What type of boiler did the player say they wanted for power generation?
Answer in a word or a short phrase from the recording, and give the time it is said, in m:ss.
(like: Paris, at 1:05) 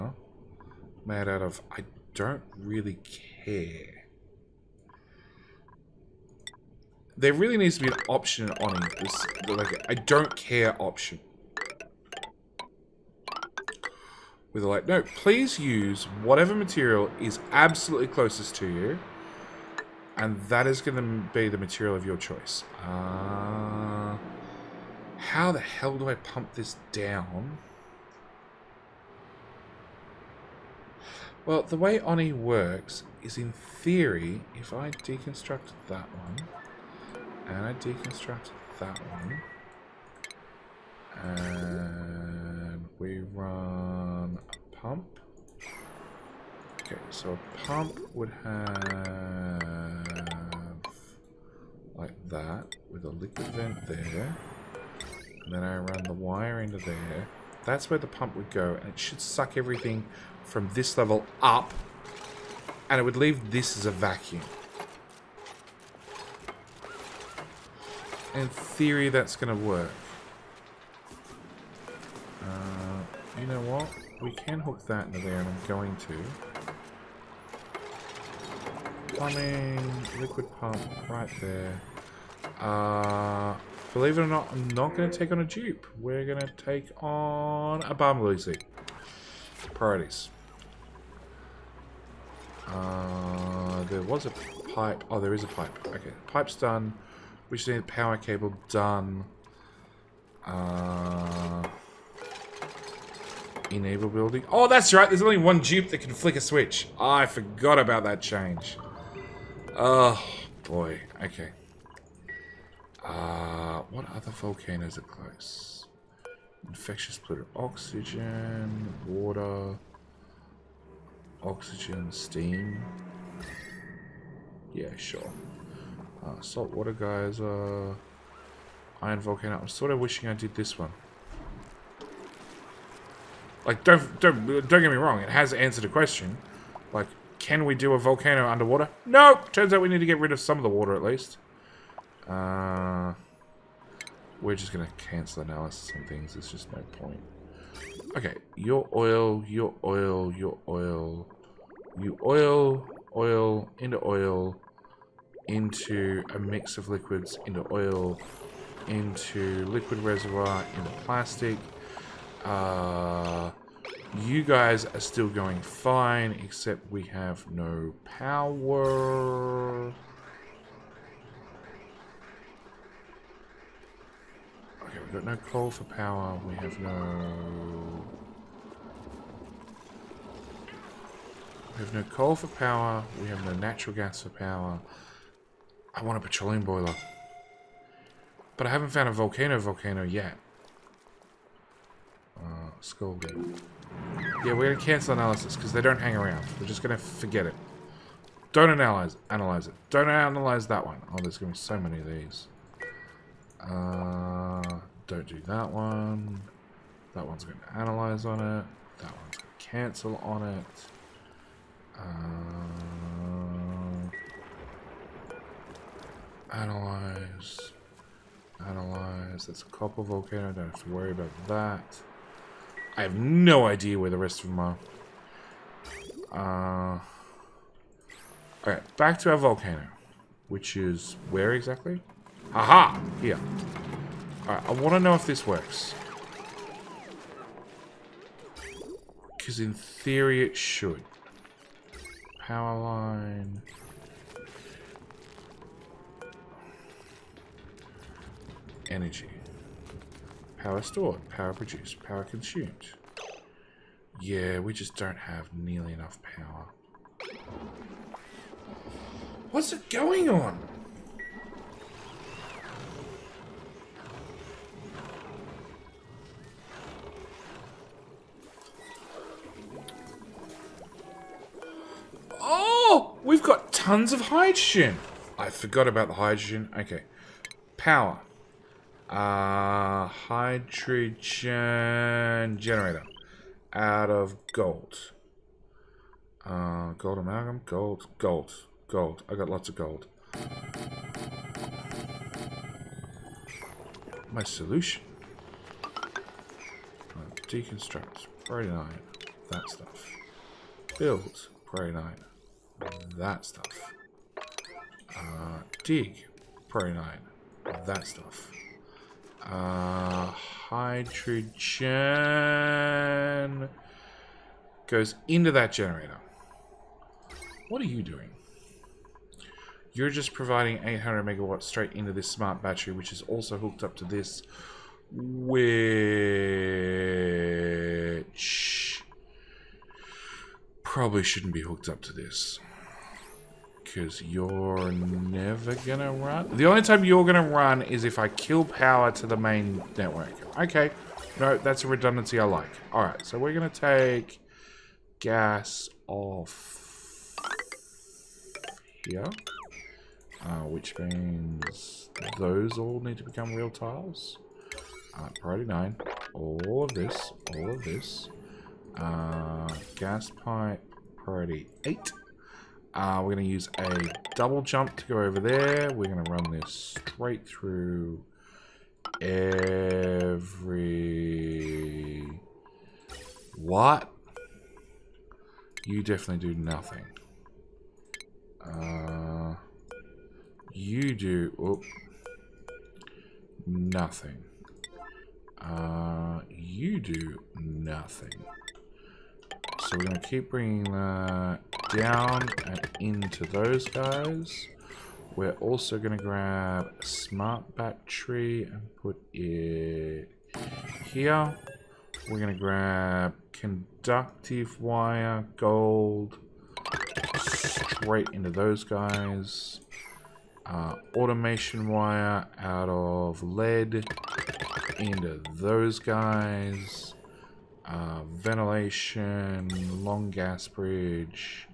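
petroleum boiler, at 3:06.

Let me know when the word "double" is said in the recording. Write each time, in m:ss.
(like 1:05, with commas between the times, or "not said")
6:04.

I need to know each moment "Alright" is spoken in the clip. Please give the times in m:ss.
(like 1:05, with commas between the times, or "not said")
3:54, 5:42.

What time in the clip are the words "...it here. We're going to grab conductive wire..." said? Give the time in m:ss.
6:39.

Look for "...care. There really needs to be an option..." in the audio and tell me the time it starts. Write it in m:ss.
0:03.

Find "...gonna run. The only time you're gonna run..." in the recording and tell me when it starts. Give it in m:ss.
5:35.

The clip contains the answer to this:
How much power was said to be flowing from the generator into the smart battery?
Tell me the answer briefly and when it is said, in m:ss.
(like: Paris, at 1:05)
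800 megawatts, at 5:20.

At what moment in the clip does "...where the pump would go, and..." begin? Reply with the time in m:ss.
0:57.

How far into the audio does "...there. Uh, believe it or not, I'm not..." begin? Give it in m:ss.
1:21.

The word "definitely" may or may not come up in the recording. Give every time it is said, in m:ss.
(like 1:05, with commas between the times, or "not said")
6:16.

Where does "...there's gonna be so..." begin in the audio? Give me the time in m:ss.
3:21.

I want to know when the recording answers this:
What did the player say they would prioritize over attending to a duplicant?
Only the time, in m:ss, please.
1:27.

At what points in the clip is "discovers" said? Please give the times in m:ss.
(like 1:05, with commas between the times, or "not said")
not said.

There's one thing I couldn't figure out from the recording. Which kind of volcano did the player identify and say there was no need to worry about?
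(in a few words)
copper volcano.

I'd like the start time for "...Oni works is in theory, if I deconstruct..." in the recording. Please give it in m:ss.
0:31.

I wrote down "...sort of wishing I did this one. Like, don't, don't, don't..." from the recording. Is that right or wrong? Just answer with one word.
right.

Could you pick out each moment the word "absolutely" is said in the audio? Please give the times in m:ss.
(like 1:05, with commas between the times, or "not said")
0:17.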